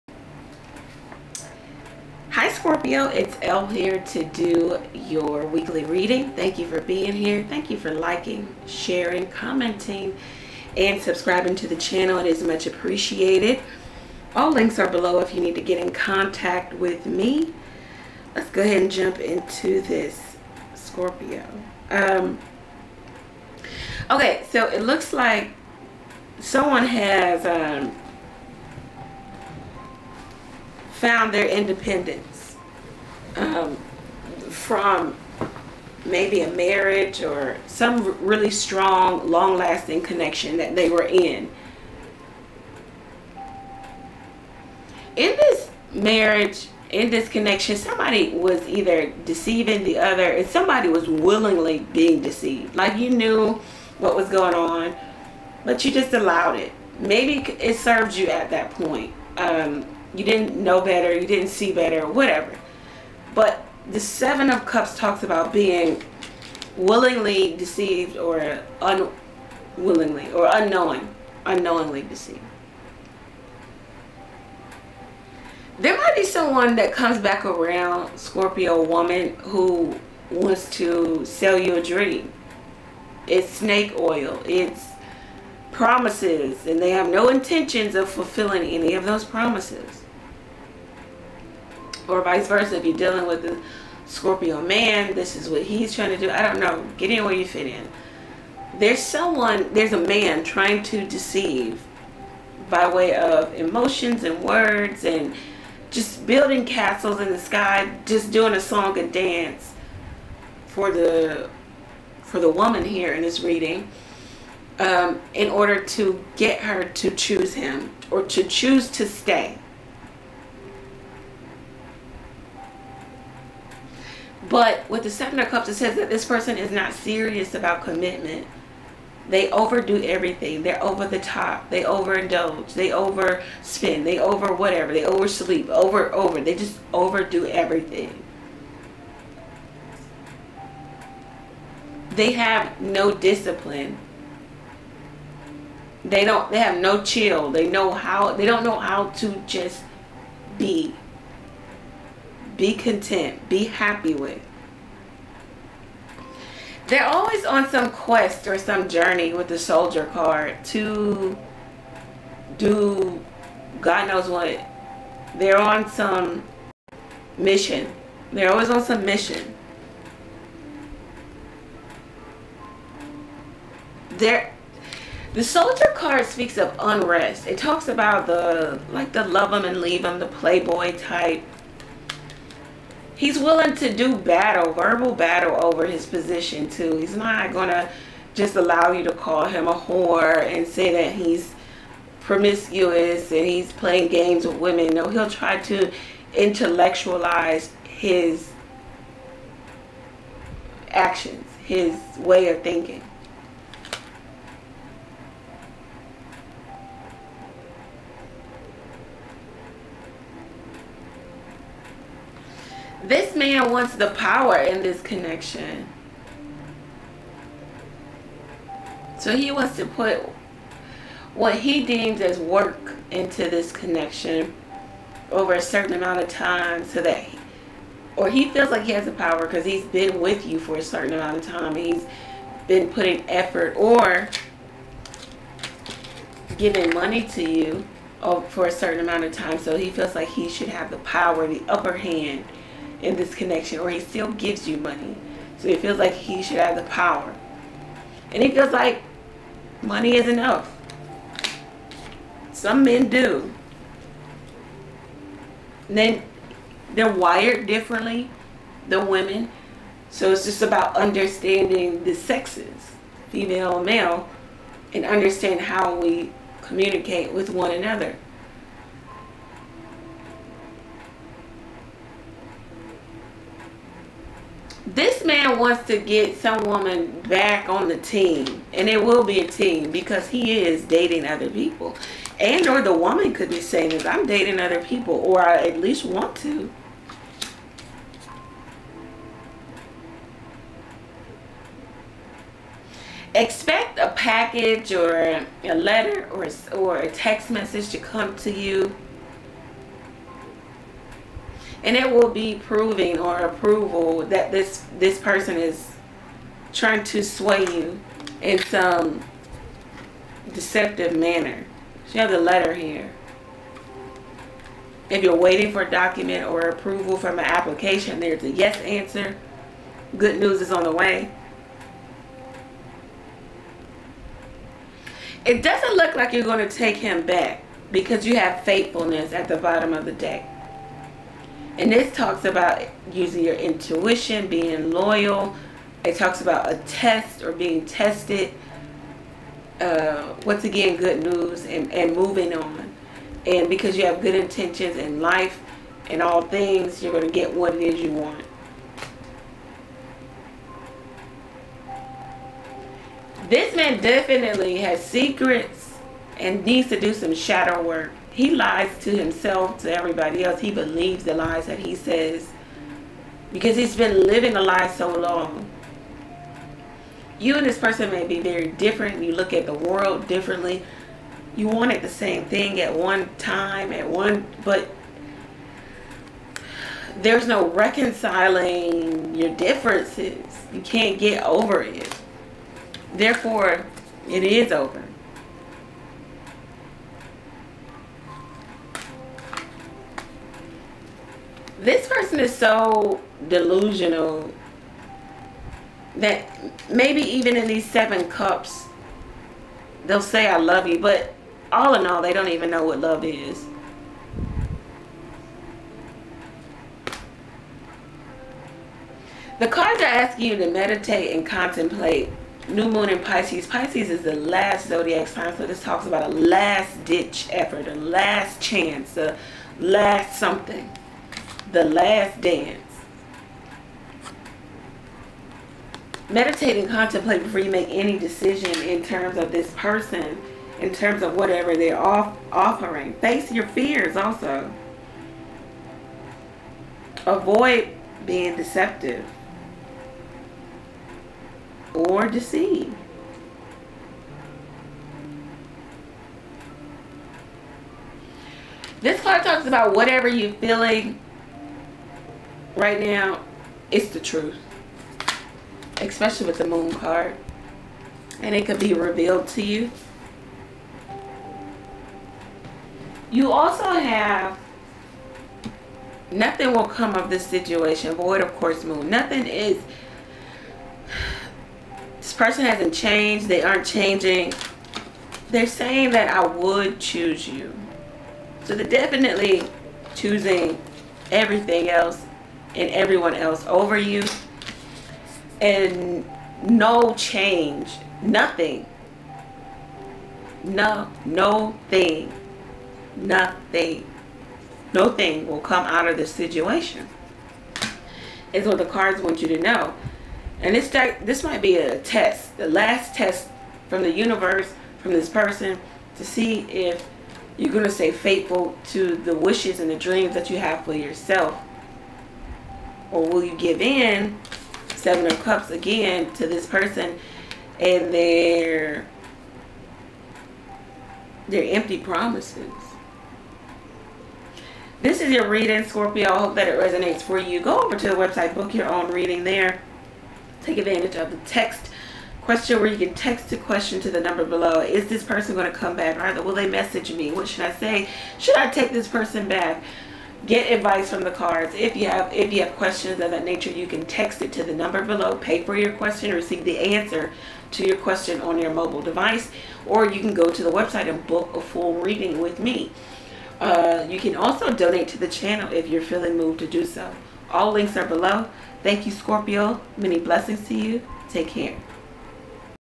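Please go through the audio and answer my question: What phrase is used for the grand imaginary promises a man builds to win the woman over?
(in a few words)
Castles in the sky.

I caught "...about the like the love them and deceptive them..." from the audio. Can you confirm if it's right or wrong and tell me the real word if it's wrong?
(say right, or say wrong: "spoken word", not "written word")
wrong: "leave", not "deceptive".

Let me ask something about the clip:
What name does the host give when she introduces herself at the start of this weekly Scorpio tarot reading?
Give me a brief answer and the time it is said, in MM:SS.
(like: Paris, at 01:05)
Elle, at 00:03.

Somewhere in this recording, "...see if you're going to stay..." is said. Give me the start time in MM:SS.
08:26.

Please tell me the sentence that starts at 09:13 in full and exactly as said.
Uh, you can also donate to the channel if you're feeling moved to do so.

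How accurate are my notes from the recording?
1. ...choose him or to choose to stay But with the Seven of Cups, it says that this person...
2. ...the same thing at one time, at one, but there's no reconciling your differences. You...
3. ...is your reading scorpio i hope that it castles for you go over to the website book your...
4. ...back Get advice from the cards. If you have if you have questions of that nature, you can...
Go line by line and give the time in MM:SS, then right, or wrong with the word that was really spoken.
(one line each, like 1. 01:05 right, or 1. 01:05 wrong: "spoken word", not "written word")
1. 01:57 right
2. 06:12 right
3. 08:45 wrong: "resonates", not "castles"
4. 08:59 right.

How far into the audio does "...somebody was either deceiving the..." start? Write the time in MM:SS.
00:47.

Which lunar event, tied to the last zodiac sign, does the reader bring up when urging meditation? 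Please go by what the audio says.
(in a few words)
New moon in Pisces.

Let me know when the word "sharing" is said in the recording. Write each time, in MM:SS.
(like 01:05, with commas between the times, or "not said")
00:08.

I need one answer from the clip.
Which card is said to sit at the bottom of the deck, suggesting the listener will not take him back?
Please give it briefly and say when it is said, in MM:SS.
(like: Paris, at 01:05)
Faithfulness, at 05:28.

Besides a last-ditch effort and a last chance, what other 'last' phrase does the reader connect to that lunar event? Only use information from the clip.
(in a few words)
The Last Dance.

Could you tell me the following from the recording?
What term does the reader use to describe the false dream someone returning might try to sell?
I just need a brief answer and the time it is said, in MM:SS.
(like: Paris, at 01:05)
Snake oil, at 01:23.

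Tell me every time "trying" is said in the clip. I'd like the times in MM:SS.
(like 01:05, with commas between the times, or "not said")
01:35, 01:40, 05:06.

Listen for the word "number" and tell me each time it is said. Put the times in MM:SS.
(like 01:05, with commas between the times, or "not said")
08:54, 09:04.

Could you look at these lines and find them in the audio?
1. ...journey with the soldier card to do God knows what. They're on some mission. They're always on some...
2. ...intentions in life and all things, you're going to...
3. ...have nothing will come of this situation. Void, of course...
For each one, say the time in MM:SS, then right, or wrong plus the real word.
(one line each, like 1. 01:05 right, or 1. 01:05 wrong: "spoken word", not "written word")
1. 02:38 right
2. 05:44 right
3. 07:43 right.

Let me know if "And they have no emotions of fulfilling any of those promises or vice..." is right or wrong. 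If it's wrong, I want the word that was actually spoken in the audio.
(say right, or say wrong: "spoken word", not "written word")
wrong: "intentions", not "emotions".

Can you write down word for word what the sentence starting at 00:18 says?
Let's go ahead and jump into this Scorpio.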